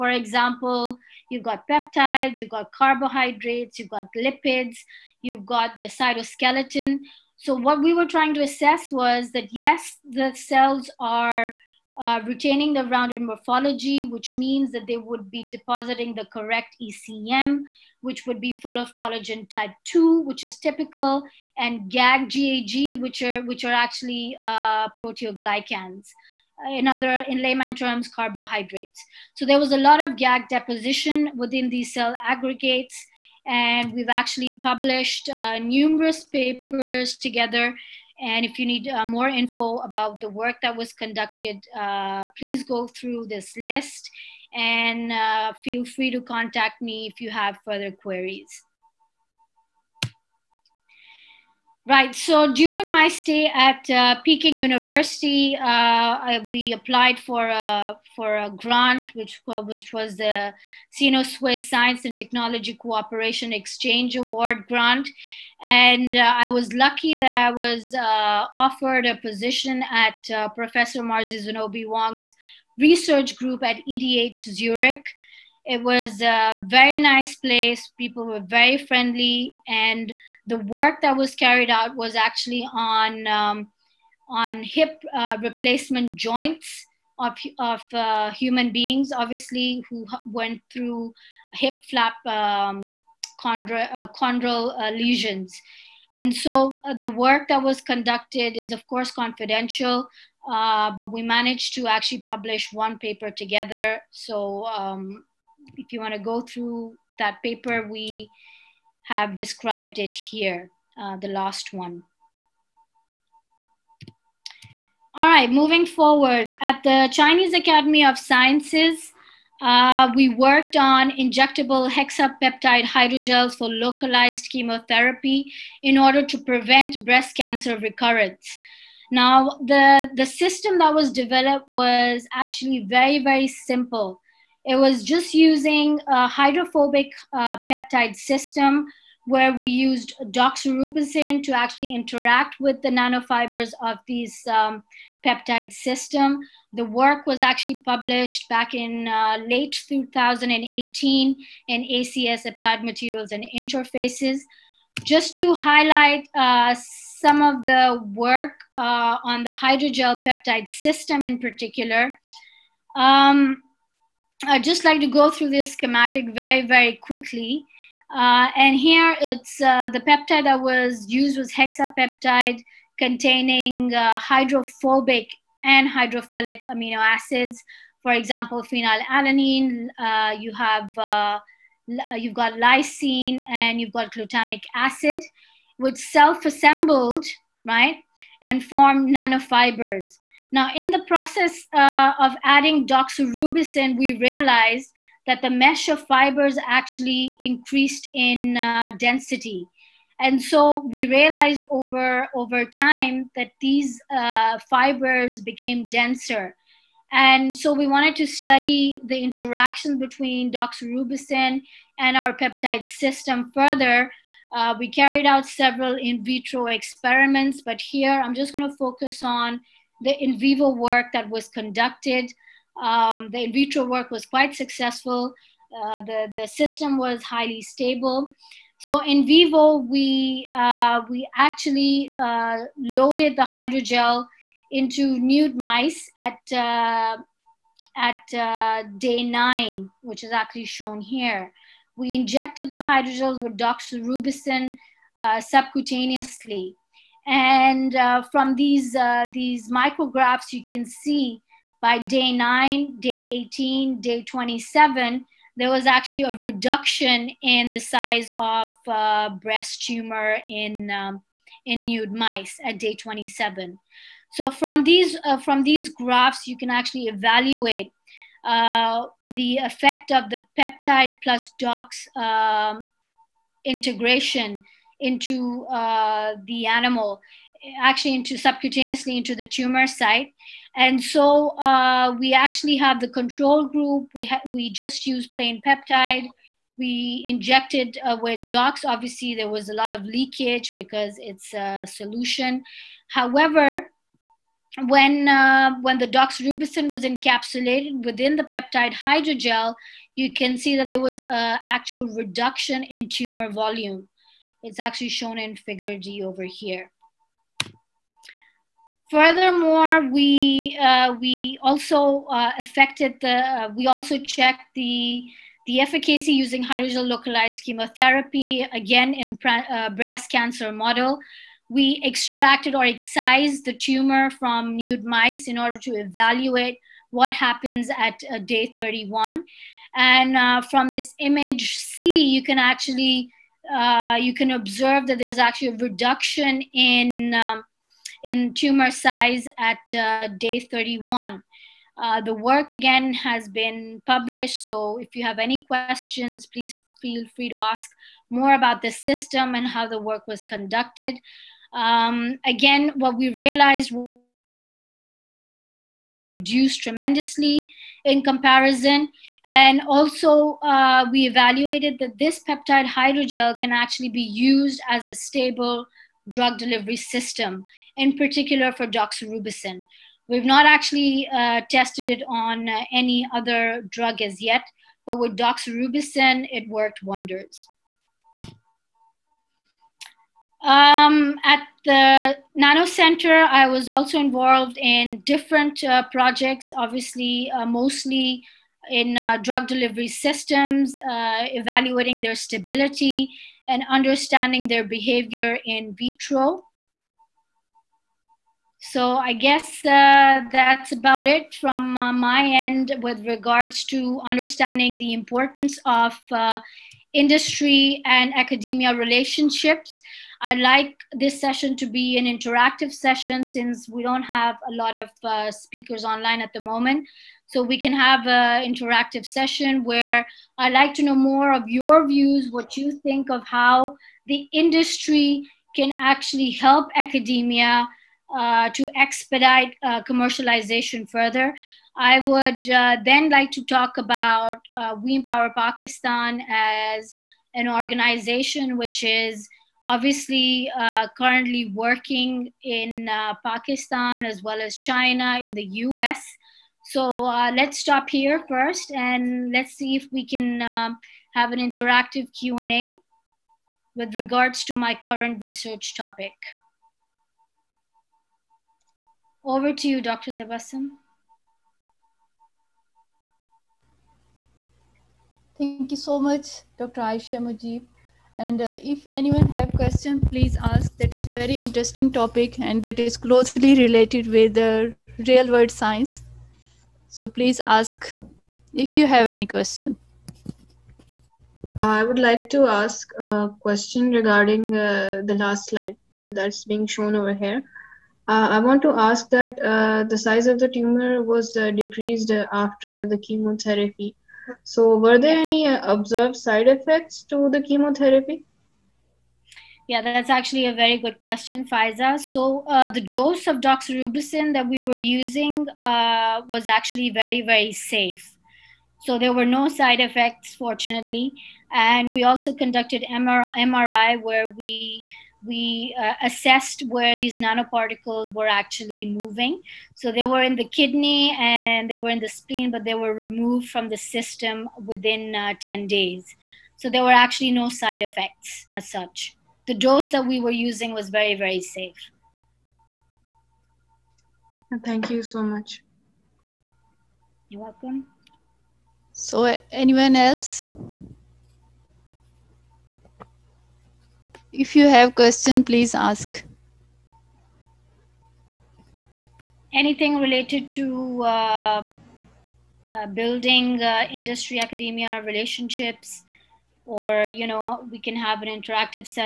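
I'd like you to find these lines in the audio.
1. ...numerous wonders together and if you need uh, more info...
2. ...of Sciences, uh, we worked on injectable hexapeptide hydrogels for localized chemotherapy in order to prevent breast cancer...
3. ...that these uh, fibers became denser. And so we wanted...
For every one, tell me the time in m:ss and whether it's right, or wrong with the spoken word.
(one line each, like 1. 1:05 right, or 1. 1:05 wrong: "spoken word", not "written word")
1. 0:35 wrong: "papers", not "wonders"
2. 1:58 right
3. 3:23 right.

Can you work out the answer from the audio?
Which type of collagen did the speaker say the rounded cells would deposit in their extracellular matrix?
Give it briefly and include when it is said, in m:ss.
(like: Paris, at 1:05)
Type 2, at 0:18.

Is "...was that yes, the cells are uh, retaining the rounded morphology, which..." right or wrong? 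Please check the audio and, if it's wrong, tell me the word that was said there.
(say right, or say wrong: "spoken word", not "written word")
right.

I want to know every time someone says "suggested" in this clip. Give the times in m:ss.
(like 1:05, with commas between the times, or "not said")
not said.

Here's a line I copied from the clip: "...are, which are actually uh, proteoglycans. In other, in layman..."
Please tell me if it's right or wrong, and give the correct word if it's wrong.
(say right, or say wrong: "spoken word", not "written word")
right.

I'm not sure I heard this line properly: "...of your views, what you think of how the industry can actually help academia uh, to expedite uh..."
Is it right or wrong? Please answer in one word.
right.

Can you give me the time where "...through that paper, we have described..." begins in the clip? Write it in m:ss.
1:46.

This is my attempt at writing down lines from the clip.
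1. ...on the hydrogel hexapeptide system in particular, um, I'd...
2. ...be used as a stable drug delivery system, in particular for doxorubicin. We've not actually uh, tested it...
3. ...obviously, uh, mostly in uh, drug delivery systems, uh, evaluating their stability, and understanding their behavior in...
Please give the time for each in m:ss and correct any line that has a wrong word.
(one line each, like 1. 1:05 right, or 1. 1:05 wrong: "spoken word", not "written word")
1. 2:39 wrong: "peptide", not "hexapeptide"
2. 6:04 right
3. 6:26 right.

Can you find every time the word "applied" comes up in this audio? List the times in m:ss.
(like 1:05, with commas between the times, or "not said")
0:56, 2:32.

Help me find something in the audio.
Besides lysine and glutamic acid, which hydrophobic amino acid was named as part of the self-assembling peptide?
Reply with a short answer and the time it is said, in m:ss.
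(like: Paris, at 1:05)
Phenylalanine, at 2:58.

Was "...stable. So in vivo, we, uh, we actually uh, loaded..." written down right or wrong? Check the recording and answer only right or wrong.
right.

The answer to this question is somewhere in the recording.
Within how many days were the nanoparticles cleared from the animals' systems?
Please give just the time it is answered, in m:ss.
8:45.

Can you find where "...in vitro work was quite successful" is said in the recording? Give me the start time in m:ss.
3:43.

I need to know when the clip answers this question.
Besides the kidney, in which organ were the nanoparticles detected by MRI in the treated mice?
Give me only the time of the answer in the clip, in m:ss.
8:42.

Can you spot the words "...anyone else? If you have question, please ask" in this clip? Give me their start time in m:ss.
8:59.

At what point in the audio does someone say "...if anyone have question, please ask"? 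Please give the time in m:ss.
7:48.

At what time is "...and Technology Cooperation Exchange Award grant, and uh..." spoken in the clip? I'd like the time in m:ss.
1:02.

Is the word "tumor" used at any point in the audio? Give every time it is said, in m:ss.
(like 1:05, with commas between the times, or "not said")
4:19, 4:39, 5:03, 5:23, 5:38, 8:10.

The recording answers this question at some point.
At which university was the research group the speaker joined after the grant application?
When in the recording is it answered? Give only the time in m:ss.
1:13.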